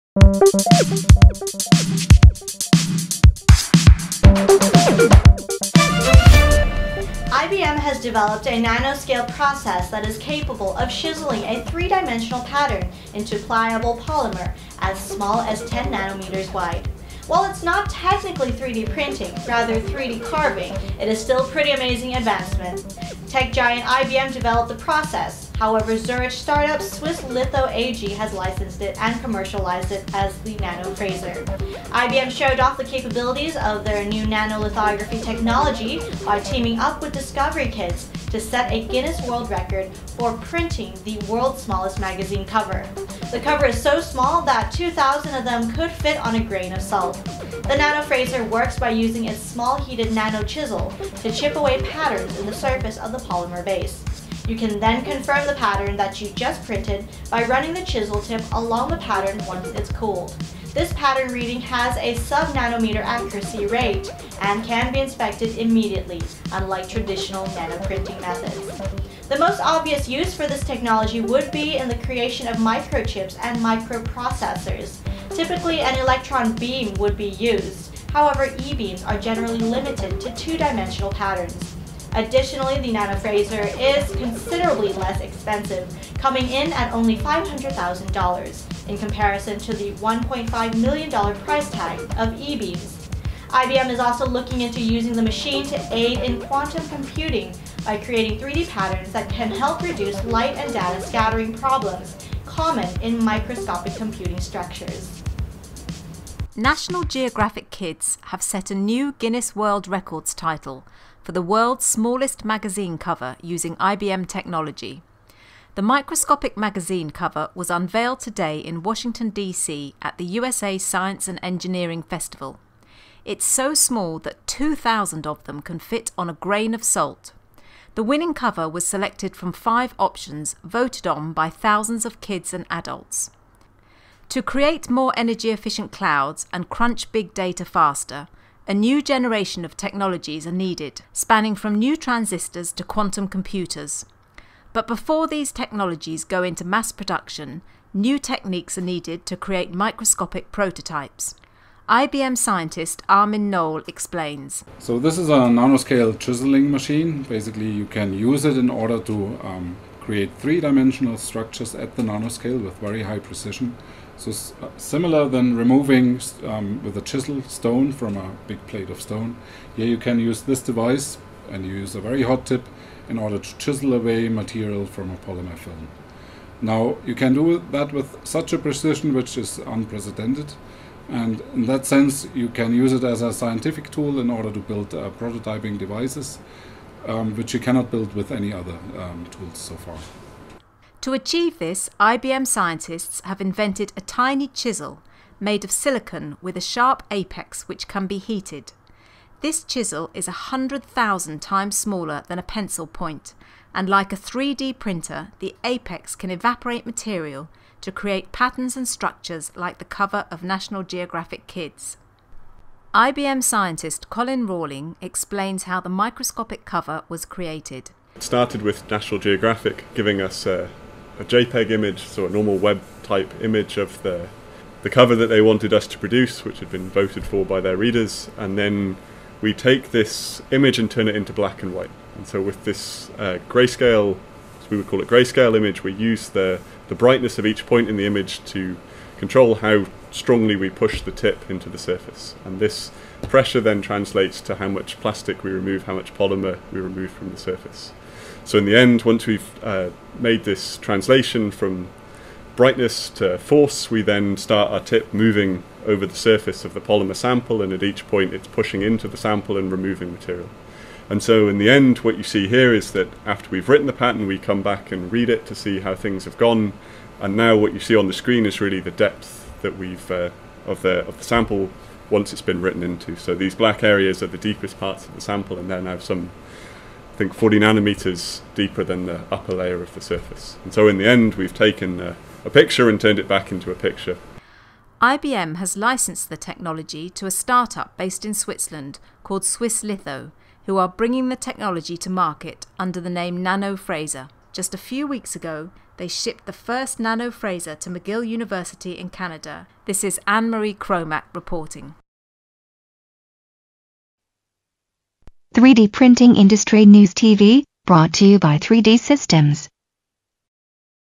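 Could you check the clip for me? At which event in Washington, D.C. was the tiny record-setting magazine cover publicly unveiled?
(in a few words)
USA Science and Engineering Festival.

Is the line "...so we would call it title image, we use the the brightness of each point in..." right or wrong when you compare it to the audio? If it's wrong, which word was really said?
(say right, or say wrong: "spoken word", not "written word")
wrong: "grayscale", not "title".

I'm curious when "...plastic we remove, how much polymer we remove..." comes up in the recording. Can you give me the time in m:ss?
4:04.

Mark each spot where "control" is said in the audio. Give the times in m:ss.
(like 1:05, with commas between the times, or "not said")
3:59.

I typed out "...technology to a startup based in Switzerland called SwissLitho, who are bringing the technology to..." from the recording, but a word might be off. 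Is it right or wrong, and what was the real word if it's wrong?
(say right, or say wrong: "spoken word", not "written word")
right.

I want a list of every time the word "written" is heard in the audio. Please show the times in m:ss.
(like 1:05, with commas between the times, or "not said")
4:23, 4:32.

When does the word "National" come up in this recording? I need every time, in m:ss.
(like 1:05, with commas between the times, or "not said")
1:46, 3:30, 3:38.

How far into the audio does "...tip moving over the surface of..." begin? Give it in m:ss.
4:14.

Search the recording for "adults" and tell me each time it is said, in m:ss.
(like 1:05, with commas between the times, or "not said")
2:12.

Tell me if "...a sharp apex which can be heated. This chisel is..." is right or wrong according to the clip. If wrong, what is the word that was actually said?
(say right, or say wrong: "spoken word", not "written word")
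right.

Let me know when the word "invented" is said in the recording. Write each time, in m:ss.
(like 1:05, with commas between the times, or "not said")
3:13.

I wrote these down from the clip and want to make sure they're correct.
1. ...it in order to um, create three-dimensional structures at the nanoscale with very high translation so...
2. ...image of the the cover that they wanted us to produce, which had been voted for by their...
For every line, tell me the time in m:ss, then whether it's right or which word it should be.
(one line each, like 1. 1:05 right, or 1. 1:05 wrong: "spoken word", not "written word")
1. 2:38 wrong: "precision", not "translation"
2. 3:43 right.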